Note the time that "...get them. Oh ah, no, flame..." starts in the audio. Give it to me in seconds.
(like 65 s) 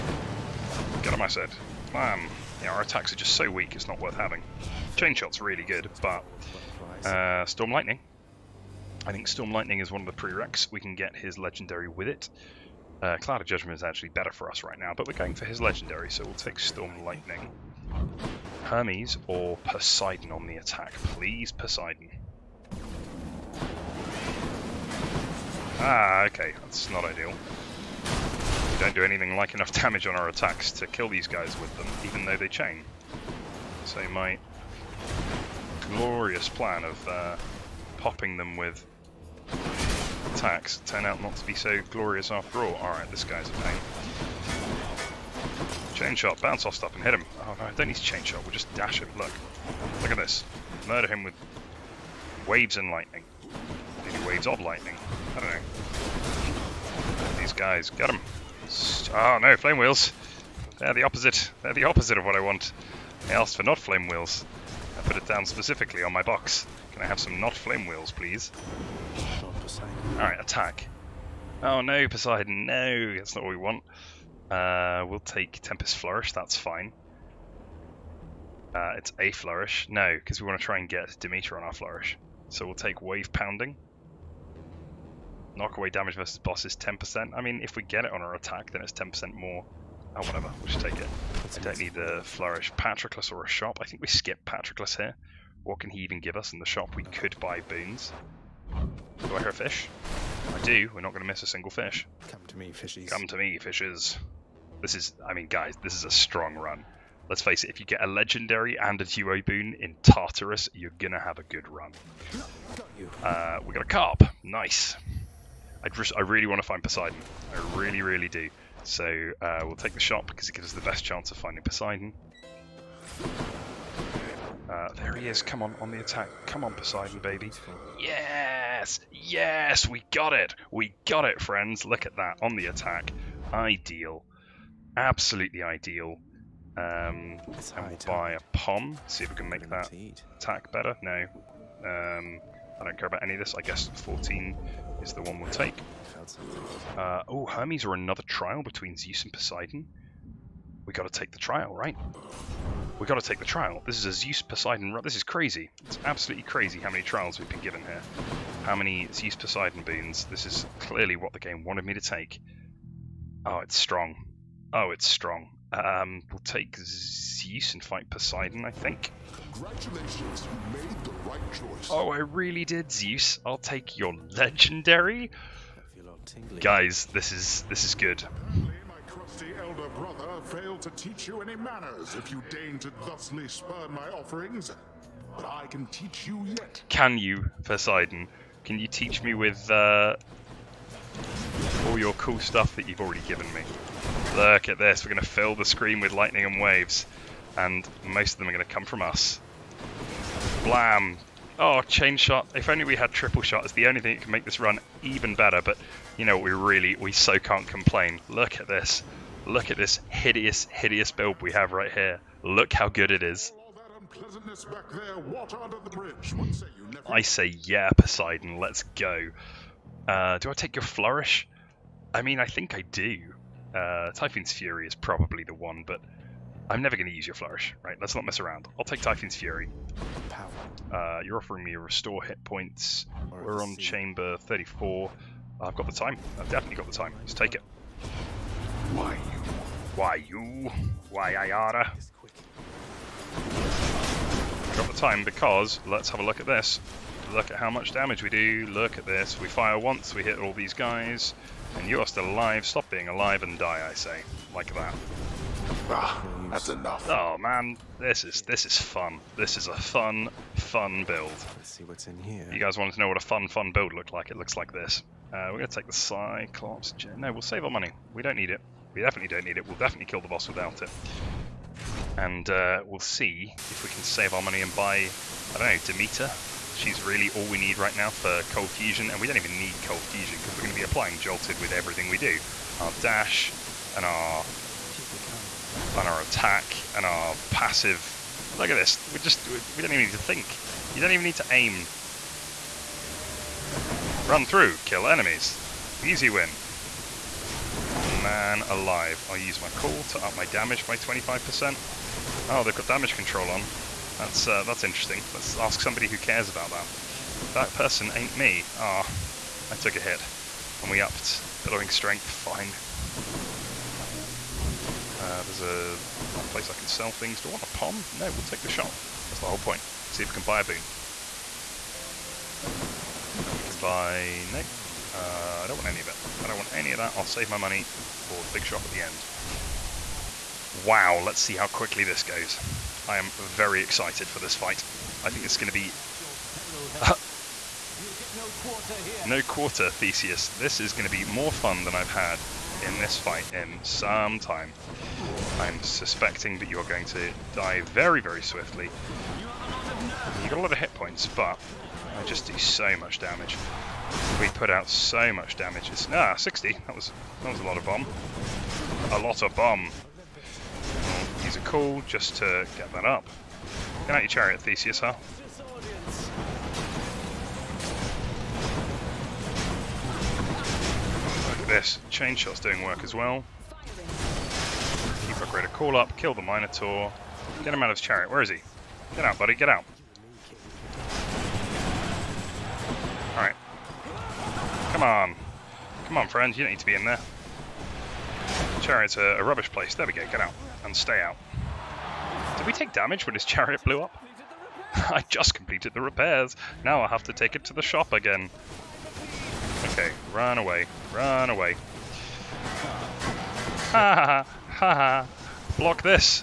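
57 s.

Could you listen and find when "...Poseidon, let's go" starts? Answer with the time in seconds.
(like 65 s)
217 s.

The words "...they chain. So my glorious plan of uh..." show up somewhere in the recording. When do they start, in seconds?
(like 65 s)
32 s.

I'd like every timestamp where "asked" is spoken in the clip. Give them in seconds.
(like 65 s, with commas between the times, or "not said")
63 s.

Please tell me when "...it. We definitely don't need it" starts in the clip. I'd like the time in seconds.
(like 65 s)
268 s.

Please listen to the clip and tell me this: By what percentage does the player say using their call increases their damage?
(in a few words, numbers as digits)
25%.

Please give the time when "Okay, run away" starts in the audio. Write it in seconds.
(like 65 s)
399 s.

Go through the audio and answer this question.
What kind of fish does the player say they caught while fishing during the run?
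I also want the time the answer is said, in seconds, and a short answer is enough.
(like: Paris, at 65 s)
Carp, at 113 s.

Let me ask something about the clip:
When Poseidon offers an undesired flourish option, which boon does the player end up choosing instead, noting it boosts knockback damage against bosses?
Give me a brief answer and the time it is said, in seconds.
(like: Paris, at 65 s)
Wave Pounding, at 83 s.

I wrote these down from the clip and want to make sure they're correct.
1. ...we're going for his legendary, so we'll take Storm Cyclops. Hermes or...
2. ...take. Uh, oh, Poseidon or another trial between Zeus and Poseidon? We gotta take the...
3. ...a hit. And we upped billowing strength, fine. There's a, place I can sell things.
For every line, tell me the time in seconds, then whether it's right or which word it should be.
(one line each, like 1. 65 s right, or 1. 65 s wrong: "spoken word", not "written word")
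1. 15 s wrong: "Lightning", not "Cyclops"
2. 145 s wrong: "Hermes", not "Poseidon"
3. 309 s right.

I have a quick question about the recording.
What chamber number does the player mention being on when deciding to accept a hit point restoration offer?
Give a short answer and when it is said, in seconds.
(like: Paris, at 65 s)
34, at 233 s.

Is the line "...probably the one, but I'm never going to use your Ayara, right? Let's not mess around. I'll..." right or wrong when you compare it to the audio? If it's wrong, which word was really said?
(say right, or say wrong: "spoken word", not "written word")
wrong: "Flourish", not "Ayara".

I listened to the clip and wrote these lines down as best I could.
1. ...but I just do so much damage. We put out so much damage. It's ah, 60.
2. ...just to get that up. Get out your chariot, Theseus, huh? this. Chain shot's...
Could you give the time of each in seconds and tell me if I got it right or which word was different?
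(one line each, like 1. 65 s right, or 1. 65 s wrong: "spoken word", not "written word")
1. 351 s right
2. 362 s right.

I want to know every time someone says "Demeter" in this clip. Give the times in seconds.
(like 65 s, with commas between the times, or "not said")
81 s, 275 s.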